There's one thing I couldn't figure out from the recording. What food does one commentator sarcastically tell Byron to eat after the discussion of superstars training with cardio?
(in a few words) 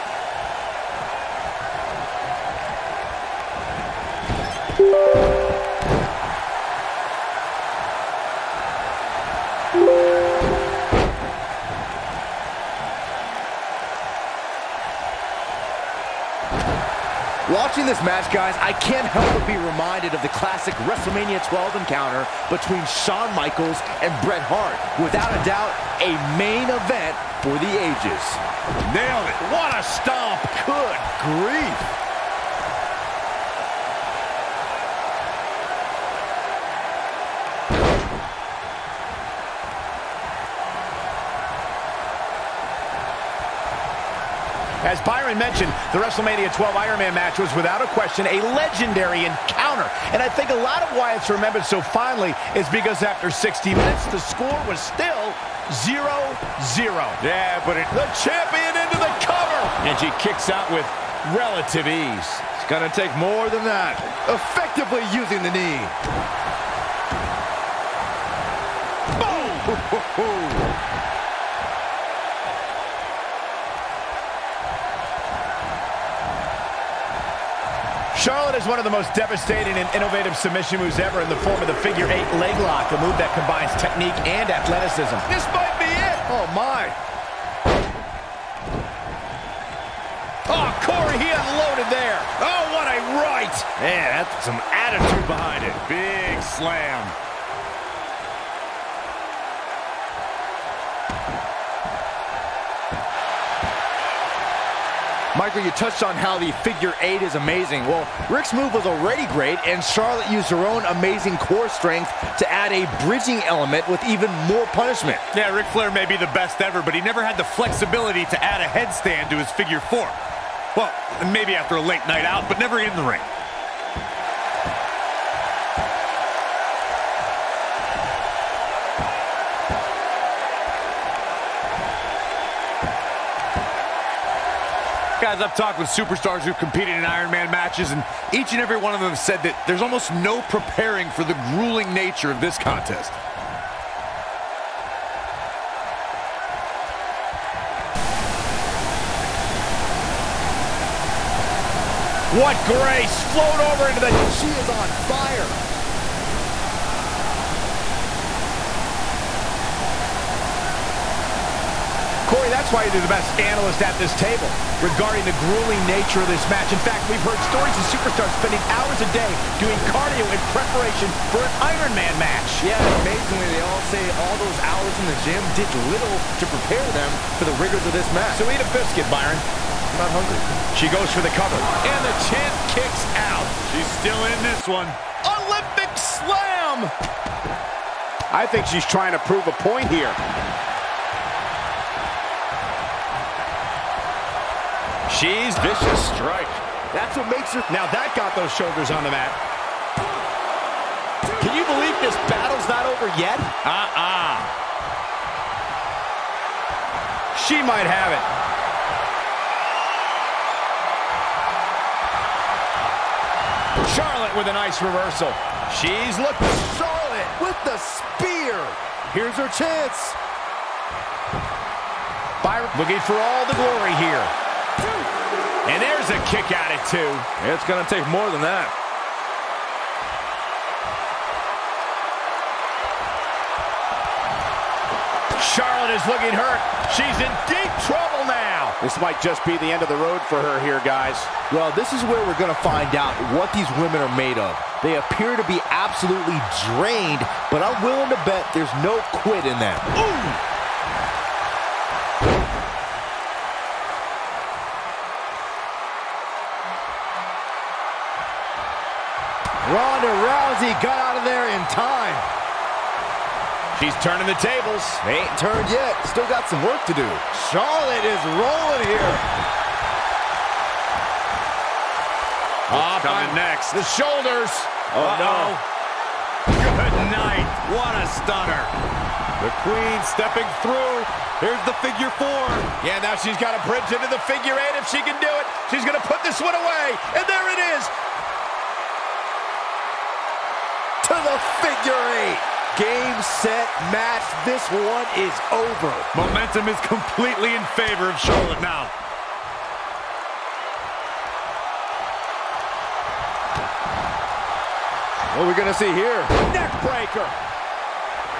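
a biscuit.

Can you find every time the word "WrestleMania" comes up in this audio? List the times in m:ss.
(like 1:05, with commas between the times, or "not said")
0:20, 0:45.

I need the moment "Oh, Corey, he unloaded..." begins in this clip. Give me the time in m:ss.
1:30.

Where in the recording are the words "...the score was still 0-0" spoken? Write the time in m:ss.
0:54.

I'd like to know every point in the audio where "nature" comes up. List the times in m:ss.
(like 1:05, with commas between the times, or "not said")
2:21, 2:45.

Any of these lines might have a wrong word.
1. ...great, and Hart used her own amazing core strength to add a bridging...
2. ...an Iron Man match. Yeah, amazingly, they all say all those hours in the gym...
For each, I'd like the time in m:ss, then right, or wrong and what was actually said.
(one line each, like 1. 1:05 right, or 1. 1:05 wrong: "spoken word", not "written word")
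1. 1:49 wrong: "Charlotte", not "Hart"
2. 2:51 right.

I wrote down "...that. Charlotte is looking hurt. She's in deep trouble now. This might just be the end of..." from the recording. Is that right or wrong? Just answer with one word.
right.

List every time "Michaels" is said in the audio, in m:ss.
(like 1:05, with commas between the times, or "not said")
0:23, 1:45.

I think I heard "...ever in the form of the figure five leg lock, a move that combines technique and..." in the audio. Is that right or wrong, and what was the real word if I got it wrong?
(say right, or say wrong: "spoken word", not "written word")
wrong: "eight", not "five".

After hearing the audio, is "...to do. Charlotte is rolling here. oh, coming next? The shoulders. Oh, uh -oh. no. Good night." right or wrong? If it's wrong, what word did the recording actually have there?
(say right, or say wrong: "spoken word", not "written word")
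right.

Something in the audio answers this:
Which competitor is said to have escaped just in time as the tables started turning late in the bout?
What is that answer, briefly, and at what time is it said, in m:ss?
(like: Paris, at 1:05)
Ronda Rousey, at 4:19.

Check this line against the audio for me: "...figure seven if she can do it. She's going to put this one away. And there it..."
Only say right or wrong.
wrong.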